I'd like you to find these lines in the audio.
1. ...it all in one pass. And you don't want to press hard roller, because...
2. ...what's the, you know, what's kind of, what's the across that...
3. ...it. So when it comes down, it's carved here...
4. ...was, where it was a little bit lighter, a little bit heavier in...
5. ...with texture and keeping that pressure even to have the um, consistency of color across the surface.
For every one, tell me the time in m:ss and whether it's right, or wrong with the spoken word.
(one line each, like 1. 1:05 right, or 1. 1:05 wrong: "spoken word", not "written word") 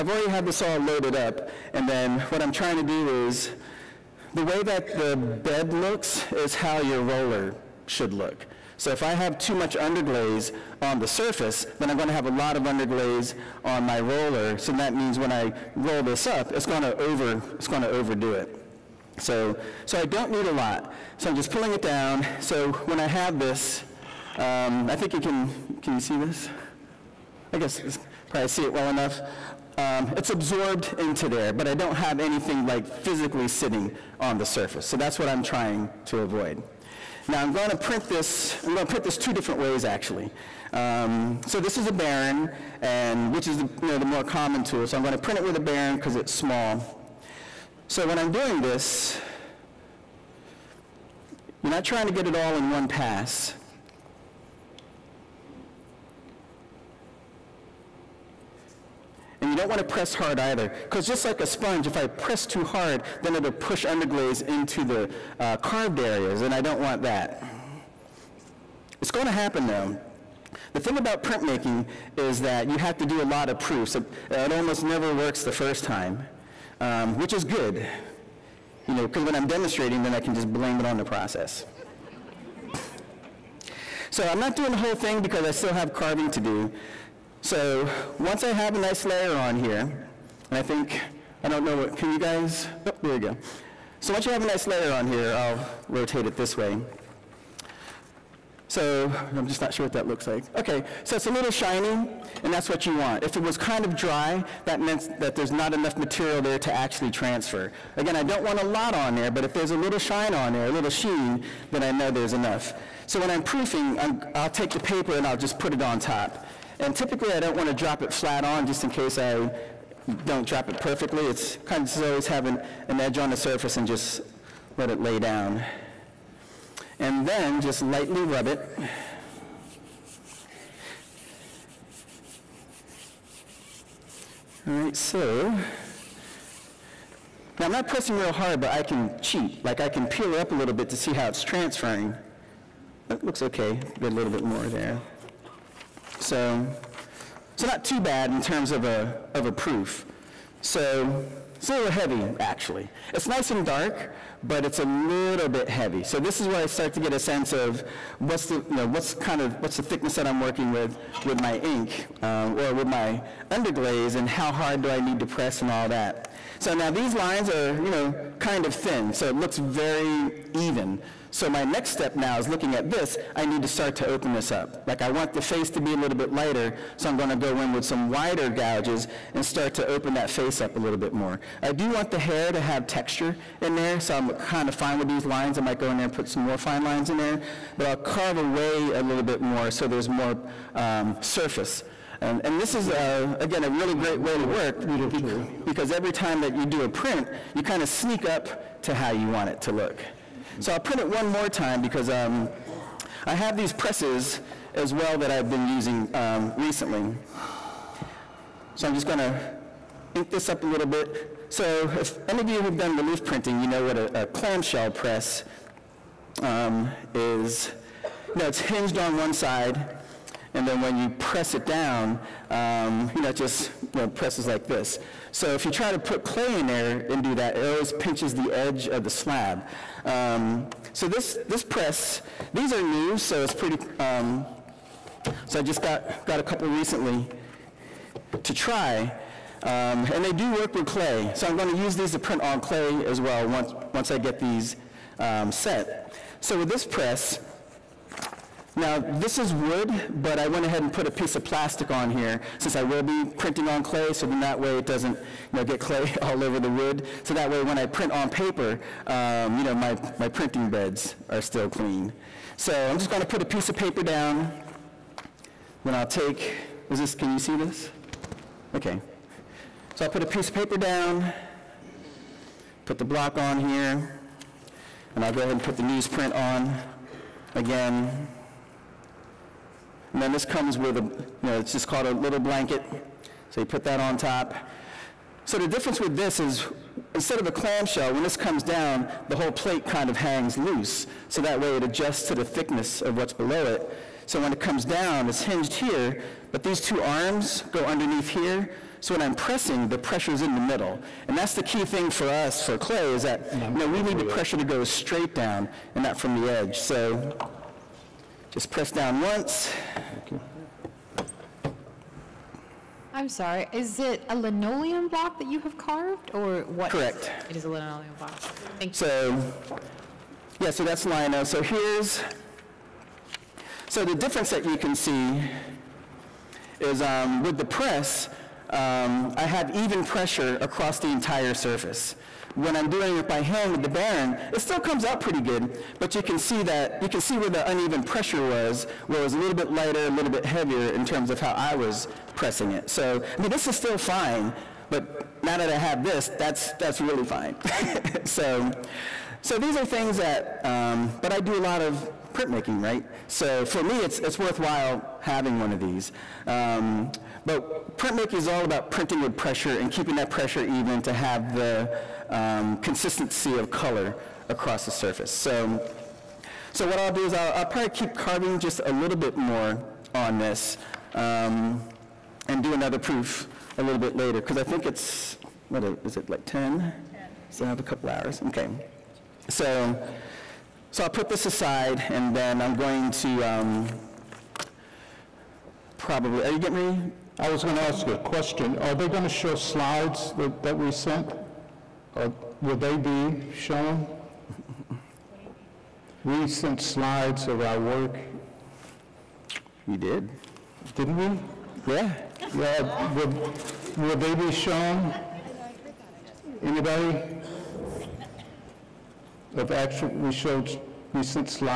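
1. 0:52 wrong: "either", not "roller"
2. 2:38 wrong: "thickness", not "across"
3. 4:53 wrong: "hinged", not "carved"
4. 5:38 right
5. 5:59 wrong: "pressure", not "texture".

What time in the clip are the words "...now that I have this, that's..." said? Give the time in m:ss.
5:45.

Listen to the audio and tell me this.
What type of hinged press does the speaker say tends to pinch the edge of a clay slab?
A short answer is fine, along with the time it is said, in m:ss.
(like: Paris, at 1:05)
clamshell press, at 3:34.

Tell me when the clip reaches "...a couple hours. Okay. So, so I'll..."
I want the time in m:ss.
6:17.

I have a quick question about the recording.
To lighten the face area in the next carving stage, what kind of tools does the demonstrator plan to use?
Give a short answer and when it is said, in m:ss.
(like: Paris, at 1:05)
wider gouges, at 2:58.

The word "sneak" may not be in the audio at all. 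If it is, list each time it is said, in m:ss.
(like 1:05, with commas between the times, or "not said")
3:17.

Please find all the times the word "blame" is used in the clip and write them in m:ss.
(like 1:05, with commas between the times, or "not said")
1:20.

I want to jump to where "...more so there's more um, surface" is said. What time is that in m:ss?
3:09.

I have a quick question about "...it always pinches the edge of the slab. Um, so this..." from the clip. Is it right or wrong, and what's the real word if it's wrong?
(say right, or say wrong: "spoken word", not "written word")
right.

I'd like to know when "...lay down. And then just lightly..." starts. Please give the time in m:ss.
2:04.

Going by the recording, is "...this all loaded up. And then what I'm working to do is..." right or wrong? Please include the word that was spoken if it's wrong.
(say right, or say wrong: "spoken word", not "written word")
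wrong: "trying", not "working".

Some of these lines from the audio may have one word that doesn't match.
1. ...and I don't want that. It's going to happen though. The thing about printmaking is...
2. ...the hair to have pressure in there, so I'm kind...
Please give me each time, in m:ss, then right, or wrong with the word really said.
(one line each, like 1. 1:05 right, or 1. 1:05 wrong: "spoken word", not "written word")
1. 1:06 right
2. 3:02 wrong: "texture", not "pressure".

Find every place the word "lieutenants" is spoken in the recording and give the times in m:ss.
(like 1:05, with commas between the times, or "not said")
not said.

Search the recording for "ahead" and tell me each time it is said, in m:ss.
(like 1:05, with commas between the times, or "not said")
4:10, 4:35.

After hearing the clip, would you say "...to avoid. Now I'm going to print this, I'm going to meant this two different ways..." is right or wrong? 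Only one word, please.
wrong.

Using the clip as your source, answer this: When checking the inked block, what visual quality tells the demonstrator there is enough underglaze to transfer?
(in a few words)
a little shine.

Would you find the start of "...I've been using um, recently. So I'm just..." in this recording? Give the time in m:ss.
3:25.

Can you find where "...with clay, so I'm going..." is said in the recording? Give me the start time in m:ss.
4:00.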